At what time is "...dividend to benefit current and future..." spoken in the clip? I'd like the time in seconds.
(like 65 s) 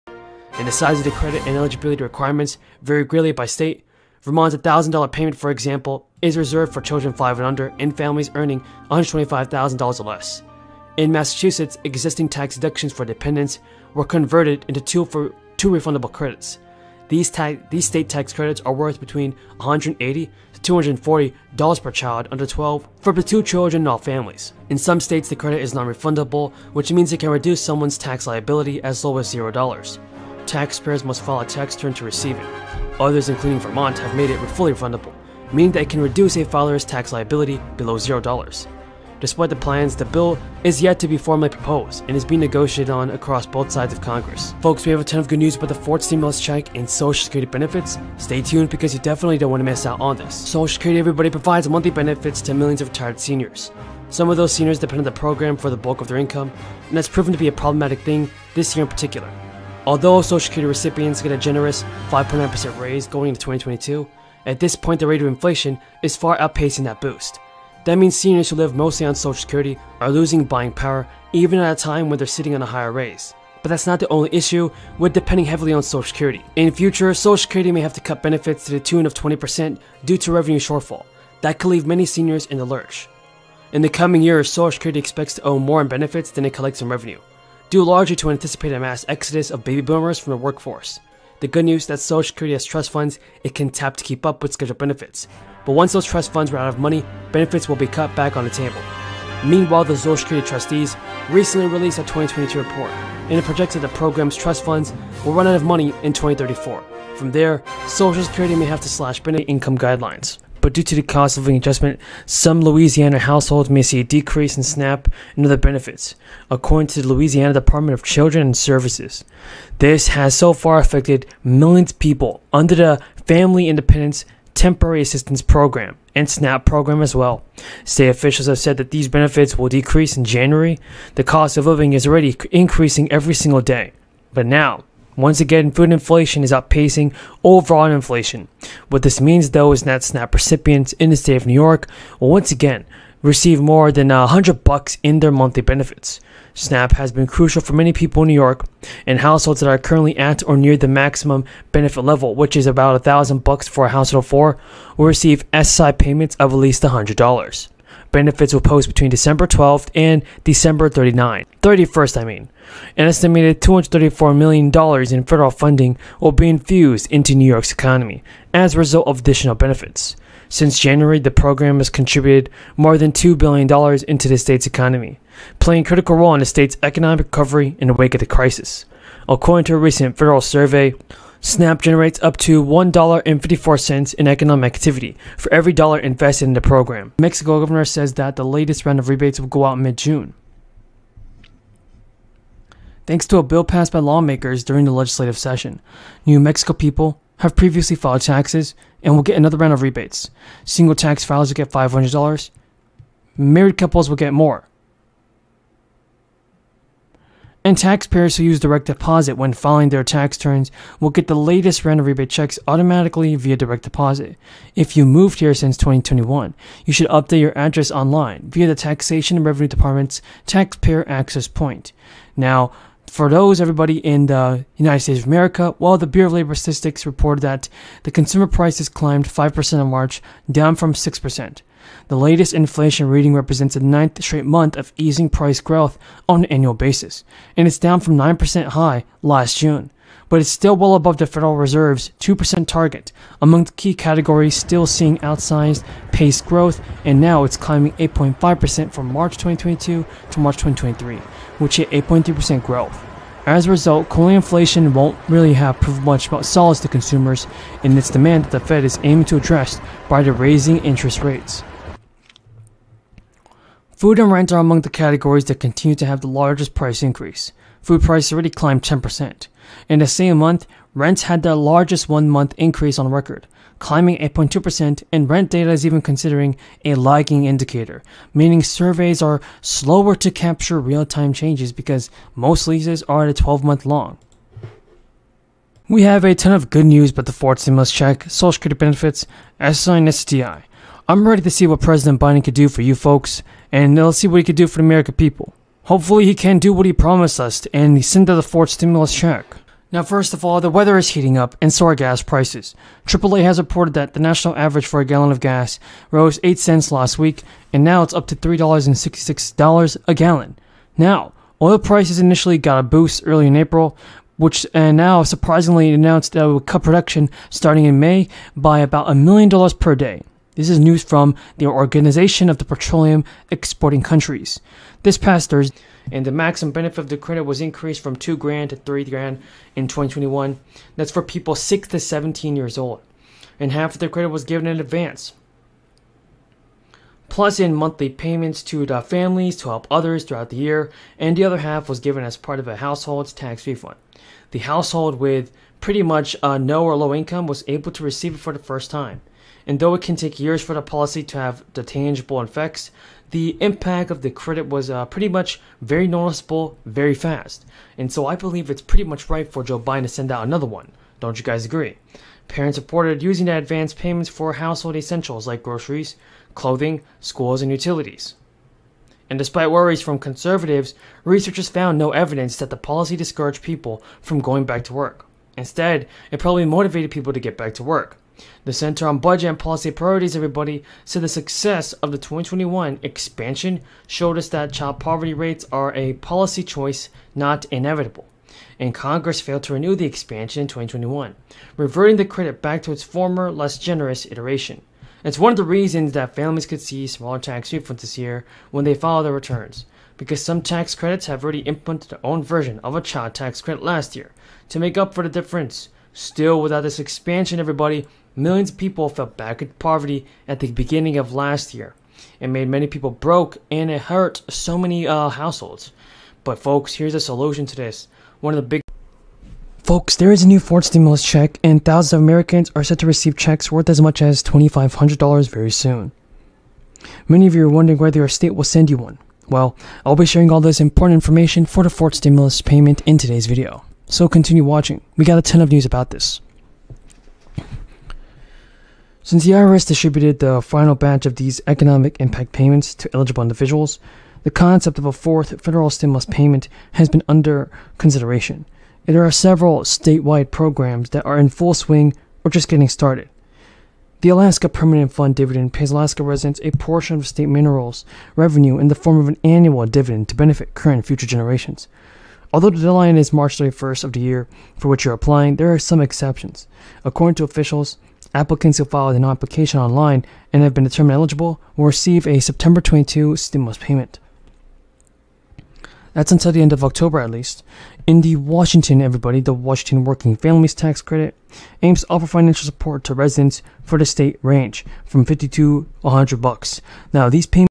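459 s.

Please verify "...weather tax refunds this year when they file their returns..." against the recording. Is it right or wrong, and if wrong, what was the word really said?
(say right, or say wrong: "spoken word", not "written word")
wrong: "smaller", not "weather".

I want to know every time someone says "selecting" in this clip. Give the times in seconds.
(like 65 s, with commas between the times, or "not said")
not said.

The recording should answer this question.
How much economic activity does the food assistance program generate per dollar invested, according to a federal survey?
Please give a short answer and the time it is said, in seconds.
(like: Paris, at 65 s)
$1.54, at 182 s.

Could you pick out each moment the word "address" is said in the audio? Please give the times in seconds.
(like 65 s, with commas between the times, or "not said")
217 s, 259 s.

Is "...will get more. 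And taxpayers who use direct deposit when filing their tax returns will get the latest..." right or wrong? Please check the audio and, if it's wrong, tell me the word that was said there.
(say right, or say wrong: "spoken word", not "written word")
right.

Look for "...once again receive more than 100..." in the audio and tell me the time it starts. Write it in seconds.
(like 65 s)
142 s.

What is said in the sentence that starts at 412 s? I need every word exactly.
It made many people broke and it hurt so many uh, households.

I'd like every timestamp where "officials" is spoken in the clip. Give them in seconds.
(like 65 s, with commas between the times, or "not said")
128 s, 467 s.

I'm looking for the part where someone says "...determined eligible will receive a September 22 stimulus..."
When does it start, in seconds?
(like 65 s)
470 s.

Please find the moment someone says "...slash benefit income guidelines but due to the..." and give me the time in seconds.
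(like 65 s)
108 s.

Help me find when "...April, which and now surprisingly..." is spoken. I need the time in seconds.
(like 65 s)
313 s.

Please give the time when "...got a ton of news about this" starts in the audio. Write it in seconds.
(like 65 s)
435 s.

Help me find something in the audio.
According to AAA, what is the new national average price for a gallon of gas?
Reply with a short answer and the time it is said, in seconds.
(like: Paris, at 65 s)
$3.66, at 308 s.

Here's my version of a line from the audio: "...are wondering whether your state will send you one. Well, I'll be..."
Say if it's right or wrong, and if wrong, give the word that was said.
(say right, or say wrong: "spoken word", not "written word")
right.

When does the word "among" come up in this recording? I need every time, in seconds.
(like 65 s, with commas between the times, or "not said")
243 s, 264 s.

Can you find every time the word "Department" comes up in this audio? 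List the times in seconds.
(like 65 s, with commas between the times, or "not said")
117 s, 219 s.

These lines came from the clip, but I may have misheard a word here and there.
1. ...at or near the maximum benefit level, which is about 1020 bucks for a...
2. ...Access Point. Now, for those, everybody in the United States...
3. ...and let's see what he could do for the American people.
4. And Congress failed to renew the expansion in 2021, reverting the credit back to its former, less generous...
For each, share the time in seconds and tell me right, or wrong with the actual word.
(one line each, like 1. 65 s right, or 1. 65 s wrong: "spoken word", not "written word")
1. 150 s wrong: "1000", not "1020"
2. 221 s right
3. 293 s right
4. 388 s right.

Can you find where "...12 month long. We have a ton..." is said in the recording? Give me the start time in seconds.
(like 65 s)
283 s.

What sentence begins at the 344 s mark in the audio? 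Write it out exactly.
The household with pretty much uh, no or low income was able to receive it for the first time.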